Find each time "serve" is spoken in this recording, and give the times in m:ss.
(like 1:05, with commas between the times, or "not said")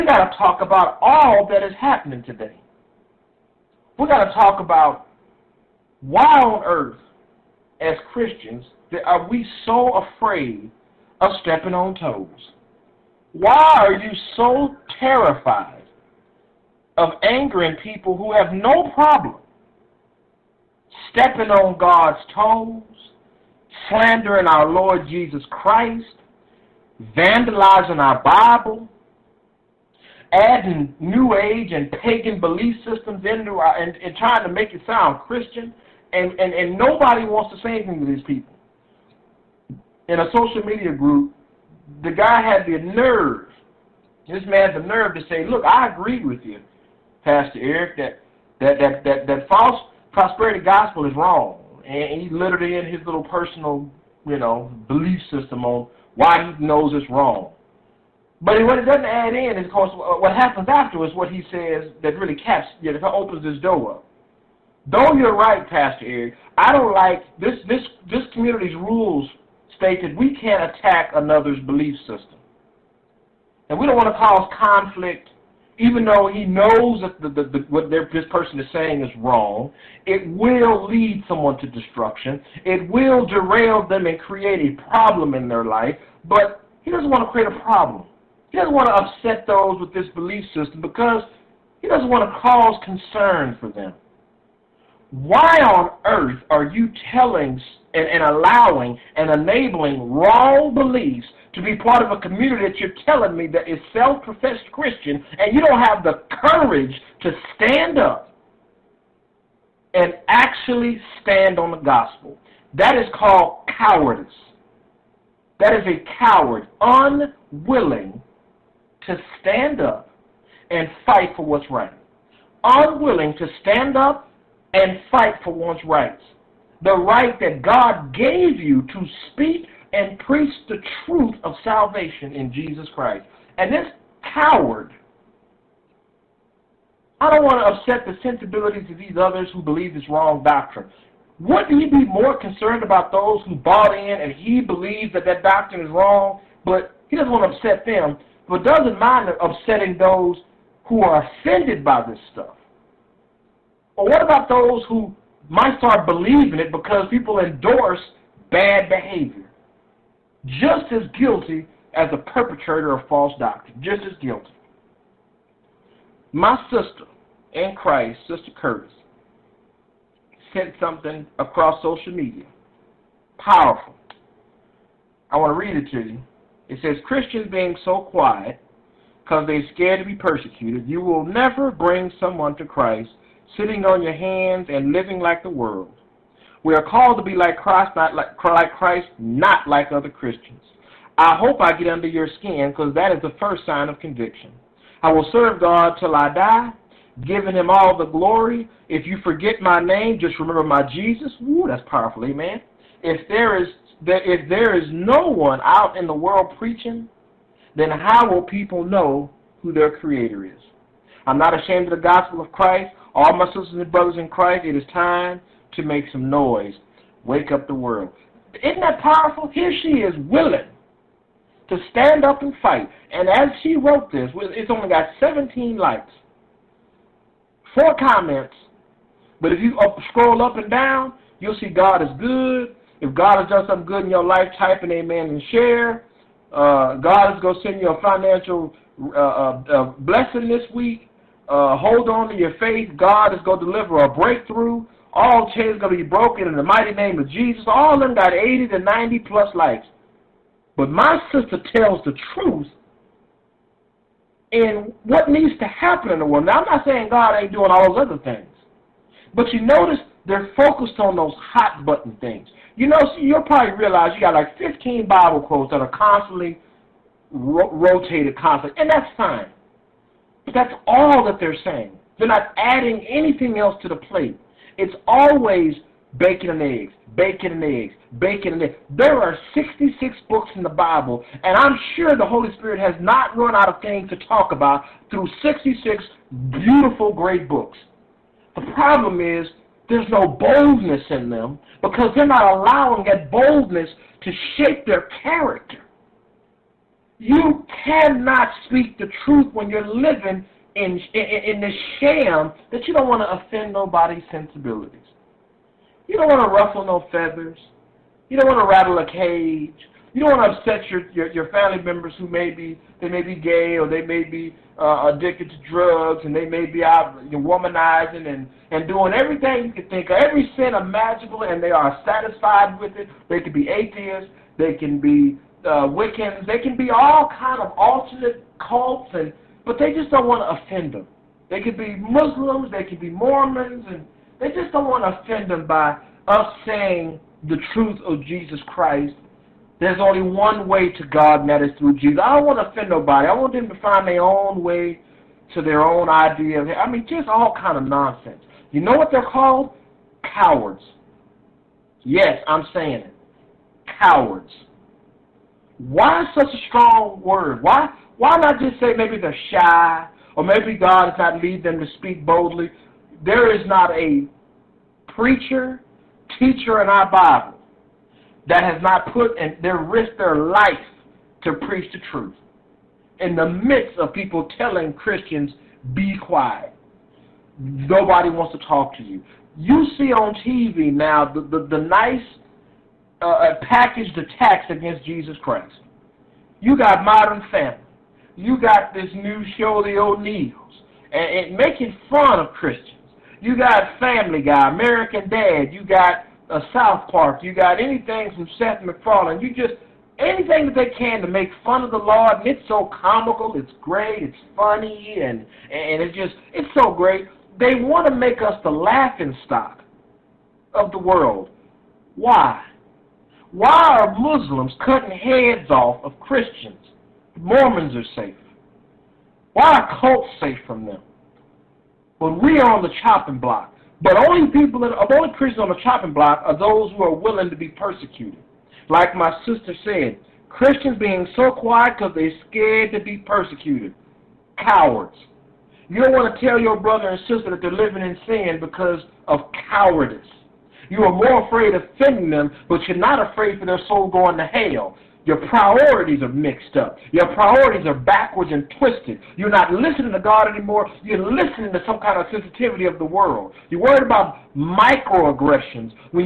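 3:15.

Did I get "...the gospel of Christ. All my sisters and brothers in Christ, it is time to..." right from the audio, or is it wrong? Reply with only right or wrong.
right.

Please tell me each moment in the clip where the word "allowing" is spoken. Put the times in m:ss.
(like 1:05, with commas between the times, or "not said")
1:38, 4:52.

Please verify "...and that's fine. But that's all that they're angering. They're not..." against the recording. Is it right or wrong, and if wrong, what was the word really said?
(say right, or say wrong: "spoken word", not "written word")
wrong: "saying", not "angering".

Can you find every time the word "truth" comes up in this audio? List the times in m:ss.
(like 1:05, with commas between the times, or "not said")
2:11, 4:12, 4:59, 5:37, 6:12.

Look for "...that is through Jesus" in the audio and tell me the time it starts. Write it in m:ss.
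5:41.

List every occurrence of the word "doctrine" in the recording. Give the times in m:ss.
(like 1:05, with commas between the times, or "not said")
2:20, 2:25, 2:43.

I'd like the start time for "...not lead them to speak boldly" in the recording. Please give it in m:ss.
6:01.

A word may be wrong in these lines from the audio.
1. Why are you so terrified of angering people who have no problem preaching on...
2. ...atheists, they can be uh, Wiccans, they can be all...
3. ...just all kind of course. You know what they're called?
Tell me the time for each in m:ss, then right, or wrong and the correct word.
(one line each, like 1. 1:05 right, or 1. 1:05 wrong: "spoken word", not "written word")
1. 0:13 wrong: "stepping", not "preaching"
2. 5:23 right
3. 5:47 wrong: "nonsense", not "course".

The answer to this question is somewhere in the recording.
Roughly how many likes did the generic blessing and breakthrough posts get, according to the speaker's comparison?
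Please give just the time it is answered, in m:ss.
4:08.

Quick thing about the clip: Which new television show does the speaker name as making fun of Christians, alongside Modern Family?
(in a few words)
The O'Neals.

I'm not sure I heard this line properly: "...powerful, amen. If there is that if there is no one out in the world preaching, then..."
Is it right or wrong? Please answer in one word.
right.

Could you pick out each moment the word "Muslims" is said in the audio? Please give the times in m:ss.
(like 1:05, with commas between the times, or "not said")
5:31, 6:54.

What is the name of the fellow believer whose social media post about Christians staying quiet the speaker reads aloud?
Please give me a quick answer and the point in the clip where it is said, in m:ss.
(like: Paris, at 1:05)
Sister Curtis, at 2:48.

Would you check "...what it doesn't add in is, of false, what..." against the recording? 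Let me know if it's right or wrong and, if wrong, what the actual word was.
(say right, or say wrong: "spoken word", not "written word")
wrong: "course", not "false".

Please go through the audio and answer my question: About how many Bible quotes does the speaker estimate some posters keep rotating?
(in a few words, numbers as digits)
15.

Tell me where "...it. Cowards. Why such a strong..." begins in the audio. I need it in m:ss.
5:53.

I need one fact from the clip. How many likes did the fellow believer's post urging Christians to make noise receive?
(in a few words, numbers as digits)
17.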